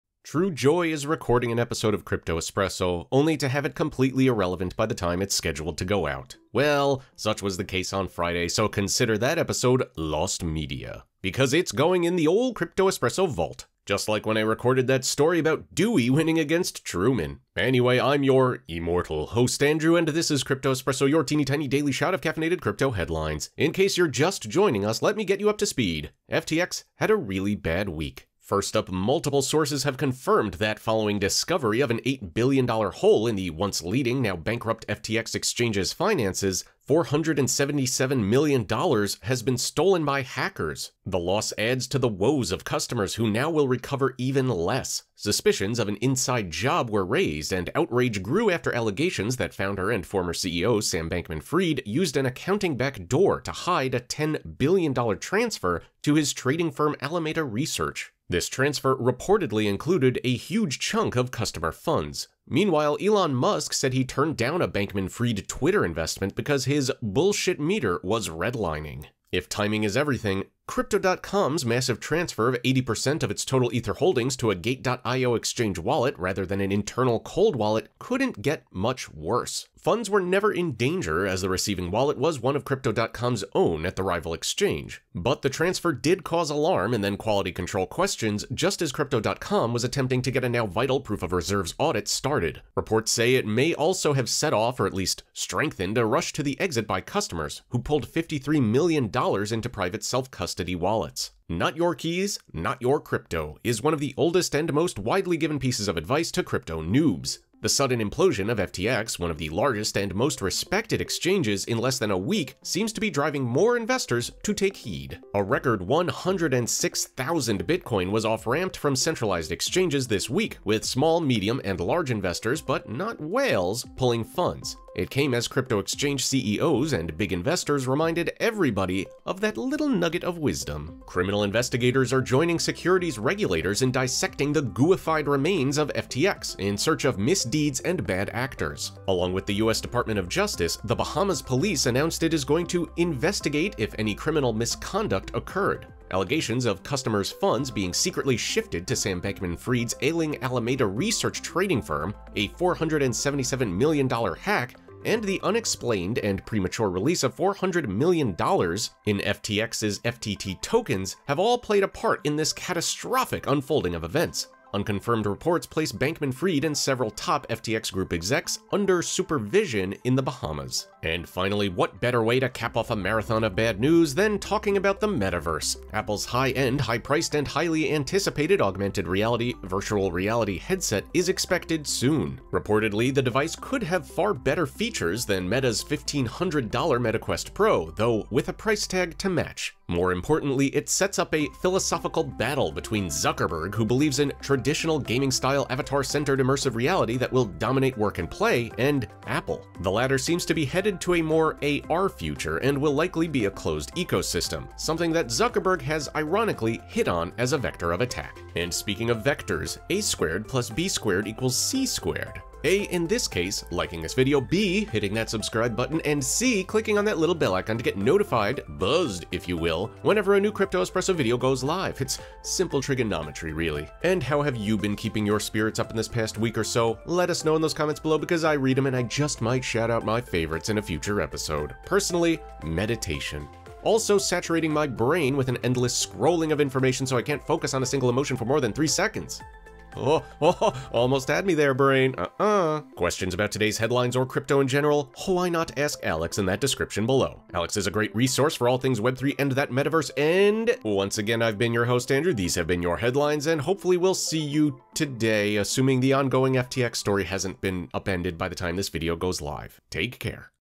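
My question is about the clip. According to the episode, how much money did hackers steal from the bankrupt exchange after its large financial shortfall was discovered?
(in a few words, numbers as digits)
$477 million.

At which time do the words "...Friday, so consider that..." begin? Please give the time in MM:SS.
00:08.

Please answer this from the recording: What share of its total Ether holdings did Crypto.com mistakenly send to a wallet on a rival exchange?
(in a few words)
80%.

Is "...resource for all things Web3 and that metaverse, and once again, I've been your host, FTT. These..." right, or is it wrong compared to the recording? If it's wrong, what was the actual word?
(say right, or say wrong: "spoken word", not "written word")
wrong: "Andrew", not "FTT".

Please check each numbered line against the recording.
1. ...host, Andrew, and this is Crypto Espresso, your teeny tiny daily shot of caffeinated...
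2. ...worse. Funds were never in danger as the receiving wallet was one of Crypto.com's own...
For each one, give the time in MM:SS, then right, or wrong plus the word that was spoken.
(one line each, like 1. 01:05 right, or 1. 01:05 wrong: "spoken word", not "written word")
1. 00:19 right
2. 01:19 right.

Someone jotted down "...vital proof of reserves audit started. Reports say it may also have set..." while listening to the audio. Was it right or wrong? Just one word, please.
right.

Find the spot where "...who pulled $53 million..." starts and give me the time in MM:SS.
01:37.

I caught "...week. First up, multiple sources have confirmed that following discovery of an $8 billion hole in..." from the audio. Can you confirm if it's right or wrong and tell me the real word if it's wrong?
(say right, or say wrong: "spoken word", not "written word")
right.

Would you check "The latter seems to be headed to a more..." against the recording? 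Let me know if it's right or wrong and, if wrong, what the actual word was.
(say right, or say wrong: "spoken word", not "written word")
right.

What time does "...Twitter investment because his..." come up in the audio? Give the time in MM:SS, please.
01:05.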